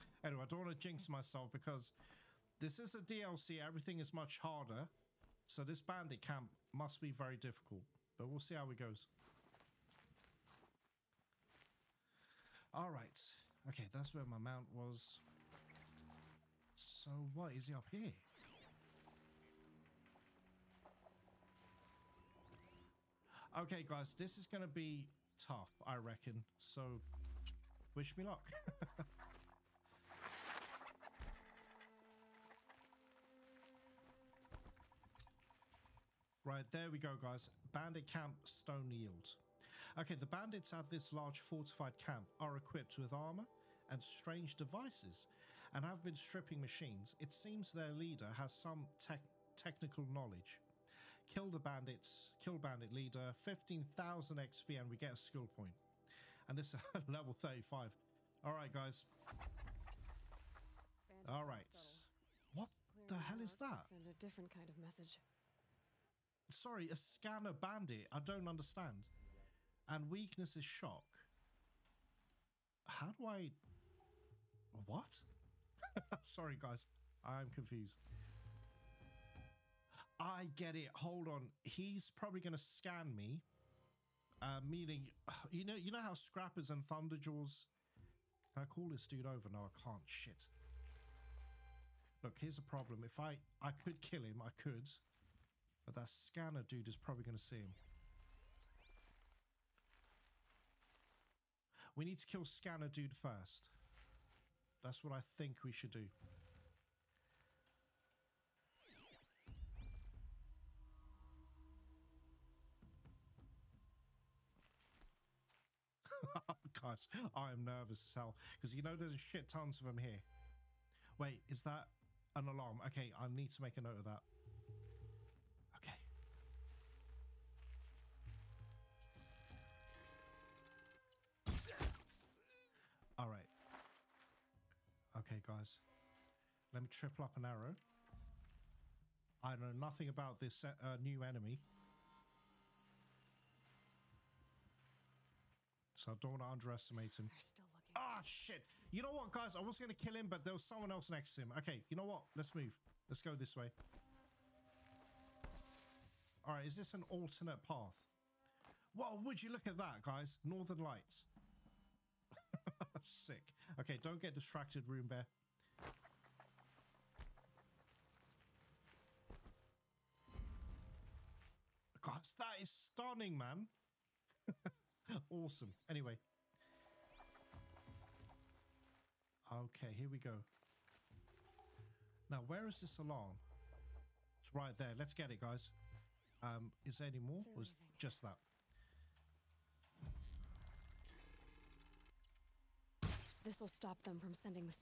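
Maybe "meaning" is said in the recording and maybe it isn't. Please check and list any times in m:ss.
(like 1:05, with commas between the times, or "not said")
1:24.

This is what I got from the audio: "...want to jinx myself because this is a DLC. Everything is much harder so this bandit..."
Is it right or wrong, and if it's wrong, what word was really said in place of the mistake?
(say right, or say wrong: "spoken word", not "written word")
right.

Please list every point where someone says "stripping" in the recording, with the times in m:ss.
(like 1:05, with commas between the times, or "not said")
0:46.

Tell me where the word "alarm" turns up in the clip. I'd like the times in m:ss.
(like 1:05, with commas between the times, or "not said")
2:02, 3:02.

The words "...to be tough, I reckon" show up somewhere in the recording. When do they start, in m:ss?
0:24.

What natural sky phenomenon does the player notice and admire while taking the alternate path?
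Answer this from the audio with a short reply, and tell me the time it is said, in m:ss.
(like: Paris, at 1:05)
Northern Lights, at 2:40.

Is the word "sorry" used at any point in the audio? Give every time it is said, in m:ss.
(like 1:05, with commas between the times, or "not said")
1:06, 1:16.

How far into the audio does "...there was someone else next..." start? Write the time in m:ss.
2:30.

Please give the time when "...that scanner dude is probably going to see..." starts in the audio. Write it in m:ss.
1:35.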